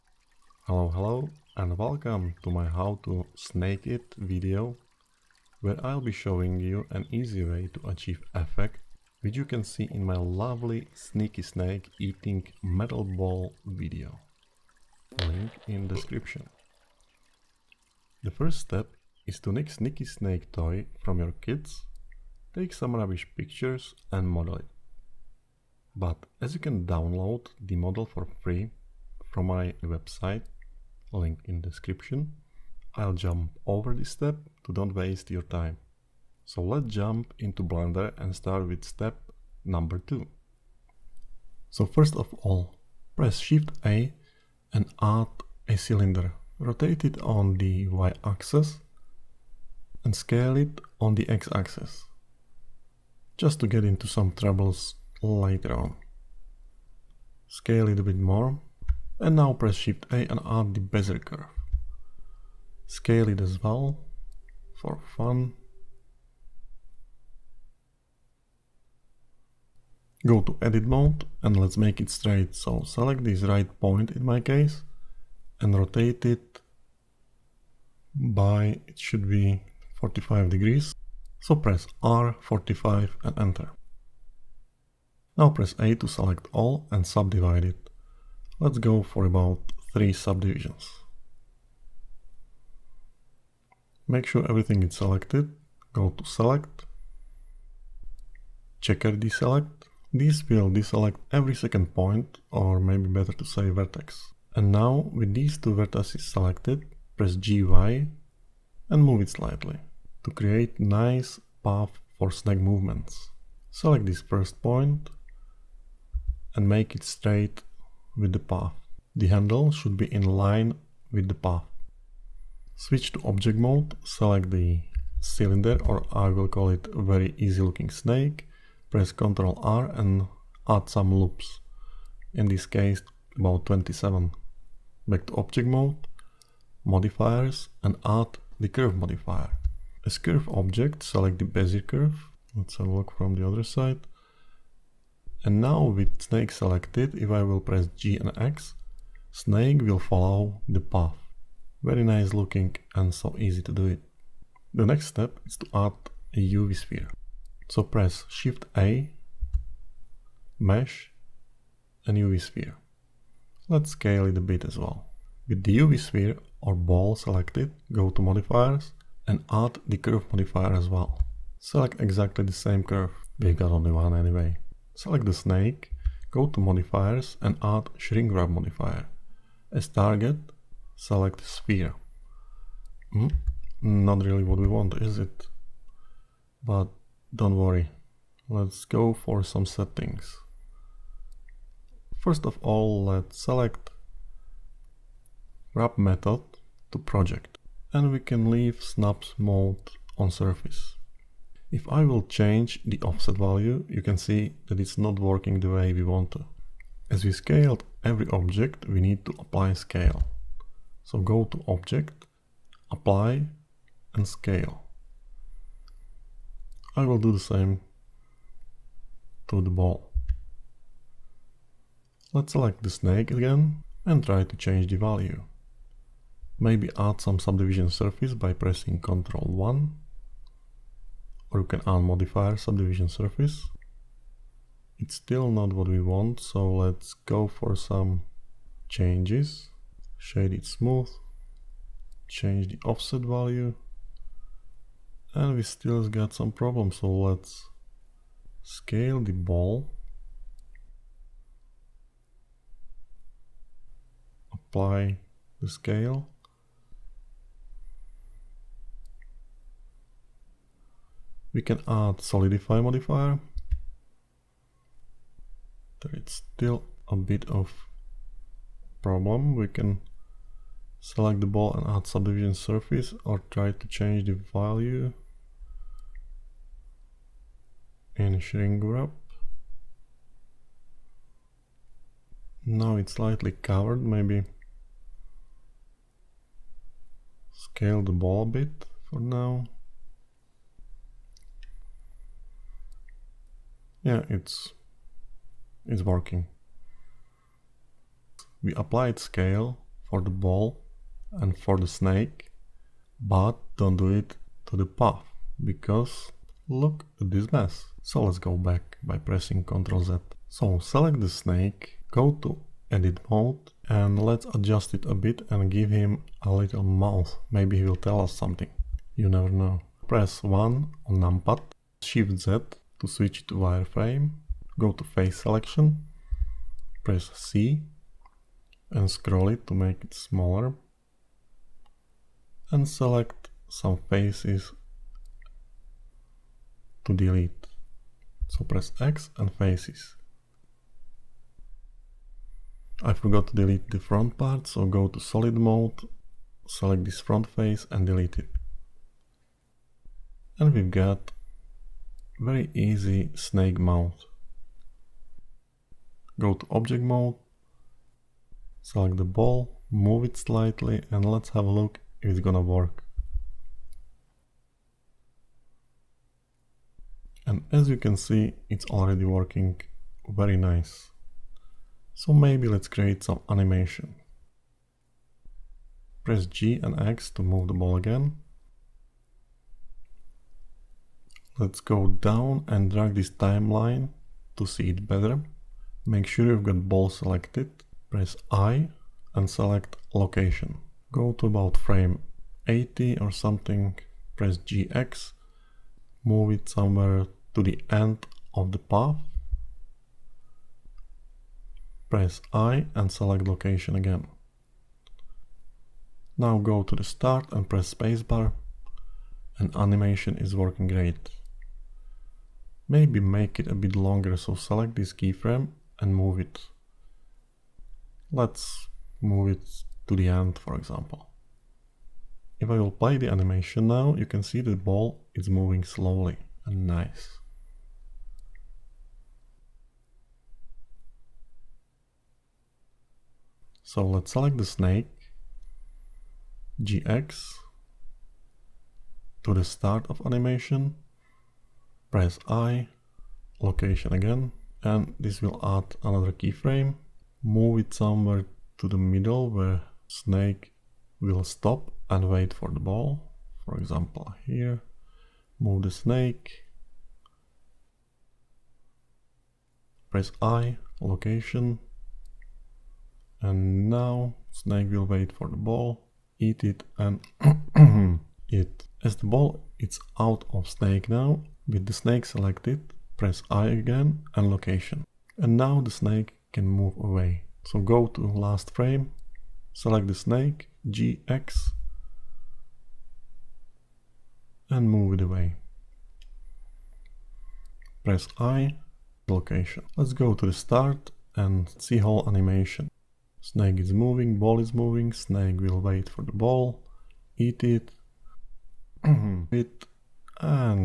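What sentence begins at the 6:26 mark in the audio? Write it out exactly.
Make sure you've got ball selected.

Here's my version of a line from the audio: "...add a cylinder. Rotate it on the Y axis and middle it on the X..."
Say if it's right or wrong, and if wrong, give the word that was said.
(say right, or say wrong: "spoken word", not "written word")
wrong: "scale", not "middle".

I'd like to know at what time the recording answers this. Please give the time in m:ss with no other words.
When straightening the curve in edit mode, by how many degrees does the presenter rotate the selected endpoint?
1:19.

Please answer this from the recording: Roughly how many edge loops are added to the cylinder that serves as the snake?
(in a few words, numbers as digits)
27.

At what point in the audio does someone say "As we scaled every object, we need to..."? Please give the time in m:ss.
3:27.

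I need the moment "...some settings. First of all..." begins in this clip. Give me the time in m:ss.
3:09.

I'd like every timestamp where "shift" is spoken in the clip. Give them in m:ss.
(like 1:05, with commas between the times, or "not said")
0:43, 0:59, 2:38, 5:22.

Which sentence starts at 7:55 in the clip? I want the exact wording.
And now the snake can move away.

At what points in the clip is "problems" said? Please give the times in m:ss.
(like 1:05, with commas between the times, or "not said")
4:06, 4:29.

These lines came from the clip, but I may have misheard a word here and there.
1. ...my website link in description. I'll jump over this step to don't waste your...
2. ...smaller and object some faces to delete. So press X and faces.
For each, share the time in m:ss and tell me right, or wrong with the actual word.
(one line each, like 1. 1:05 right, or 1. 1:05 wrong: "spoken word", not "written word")
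1. 0:29 right
2. 5:30 wrong: "select", not "object".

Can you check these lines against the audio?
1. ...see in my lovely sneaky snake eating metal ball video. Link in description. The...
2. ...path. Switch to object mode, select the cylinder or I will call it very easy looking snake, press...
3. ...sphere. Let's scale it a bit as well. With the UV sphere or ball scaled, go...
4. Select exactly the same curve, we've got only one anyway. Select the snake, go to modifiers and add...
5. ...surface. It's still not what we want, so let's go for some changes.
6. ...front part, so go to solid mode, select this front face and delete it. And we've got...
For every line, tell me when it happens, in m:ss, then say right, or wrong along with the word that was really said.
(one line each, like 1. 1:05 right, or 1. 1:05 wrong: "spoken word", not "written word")
1. 0:09 right
2. 2:01 right
3. 2:42 wrong: "selected", not "scaled"
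4. 2:51 right
5. 3:53 right
6. 5:43 right.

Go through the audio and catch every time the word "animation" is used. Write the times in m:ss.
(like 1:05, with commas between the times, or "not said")
6:13, 6:49, 7:03, 7:20, 8:12.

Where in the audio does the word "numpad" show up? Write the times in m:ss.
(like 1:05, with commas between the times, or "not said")
5:21.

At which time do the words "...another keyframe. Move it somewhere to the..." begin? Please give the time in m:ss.
7:26.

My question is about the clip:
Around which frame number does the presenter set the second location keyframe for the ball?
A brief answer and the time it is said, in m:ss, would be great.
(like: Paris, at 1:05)
80, at 6:31.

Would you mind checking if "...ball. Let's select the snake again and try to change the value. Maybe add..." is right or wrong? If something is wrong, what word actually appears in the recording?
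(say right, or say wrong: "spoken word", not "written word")
right.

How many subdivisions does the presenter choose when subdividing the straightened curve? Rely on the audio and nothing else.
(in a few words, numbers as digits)
3.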